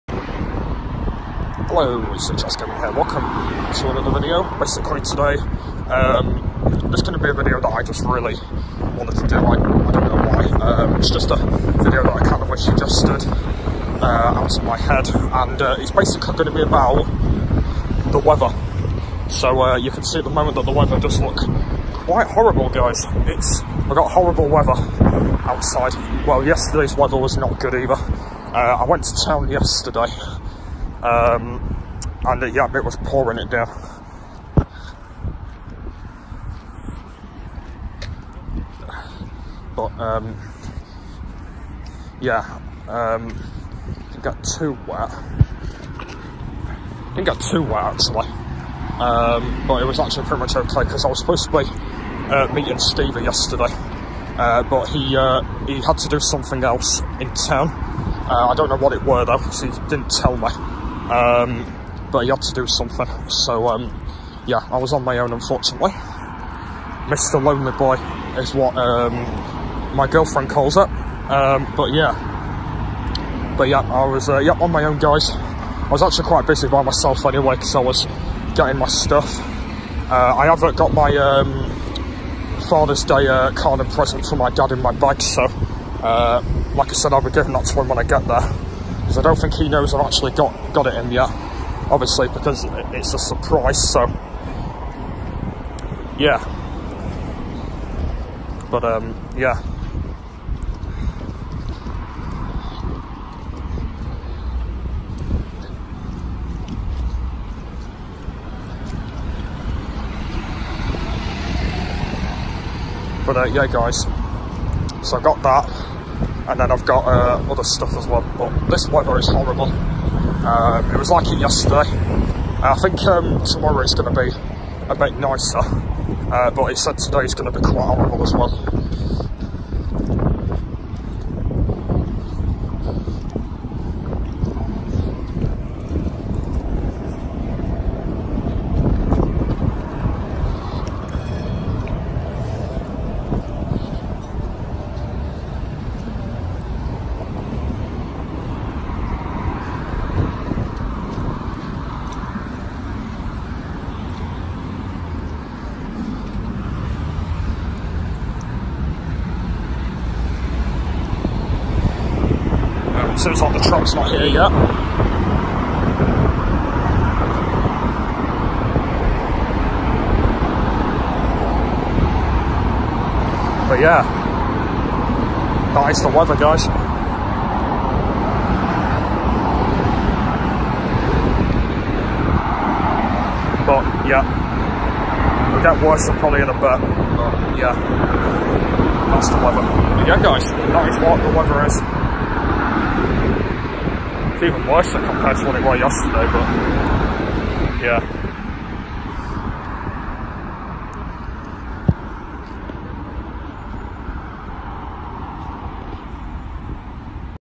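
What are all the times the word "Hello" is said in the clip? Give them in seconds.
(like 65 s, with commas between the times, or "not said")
1 s.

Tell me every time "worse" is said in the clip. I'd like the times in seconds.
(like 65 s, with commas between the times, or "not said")
185 s, 194 s.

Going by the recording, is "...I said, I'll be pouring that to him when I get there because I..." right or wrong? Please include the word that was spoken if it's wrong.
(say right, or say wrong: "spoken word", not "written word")
wrong: "giving", not "pouring".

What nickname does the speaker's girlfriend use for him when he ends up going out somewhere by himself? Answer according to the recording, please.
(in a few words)
Mr. Lonely Boy.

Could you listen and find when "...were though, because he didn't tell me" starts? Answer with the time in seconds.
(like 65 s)
59 s.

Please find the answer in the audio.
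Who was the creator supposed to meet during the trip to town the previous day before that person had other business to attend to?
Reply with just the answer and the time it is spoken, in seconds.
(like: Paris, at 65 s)
Stevie, at 52 s.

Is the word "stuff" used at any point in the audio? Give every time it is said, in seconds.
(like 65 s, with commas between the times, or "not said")
78 s, 117 s.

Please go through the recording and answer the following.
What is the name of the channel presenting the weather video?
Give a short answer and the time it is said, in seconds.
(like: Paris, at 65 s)
Jack's Gaming, at 2 s.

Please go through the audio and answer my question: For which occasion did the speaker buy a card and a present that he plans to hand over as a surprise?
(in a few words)
Father's Day.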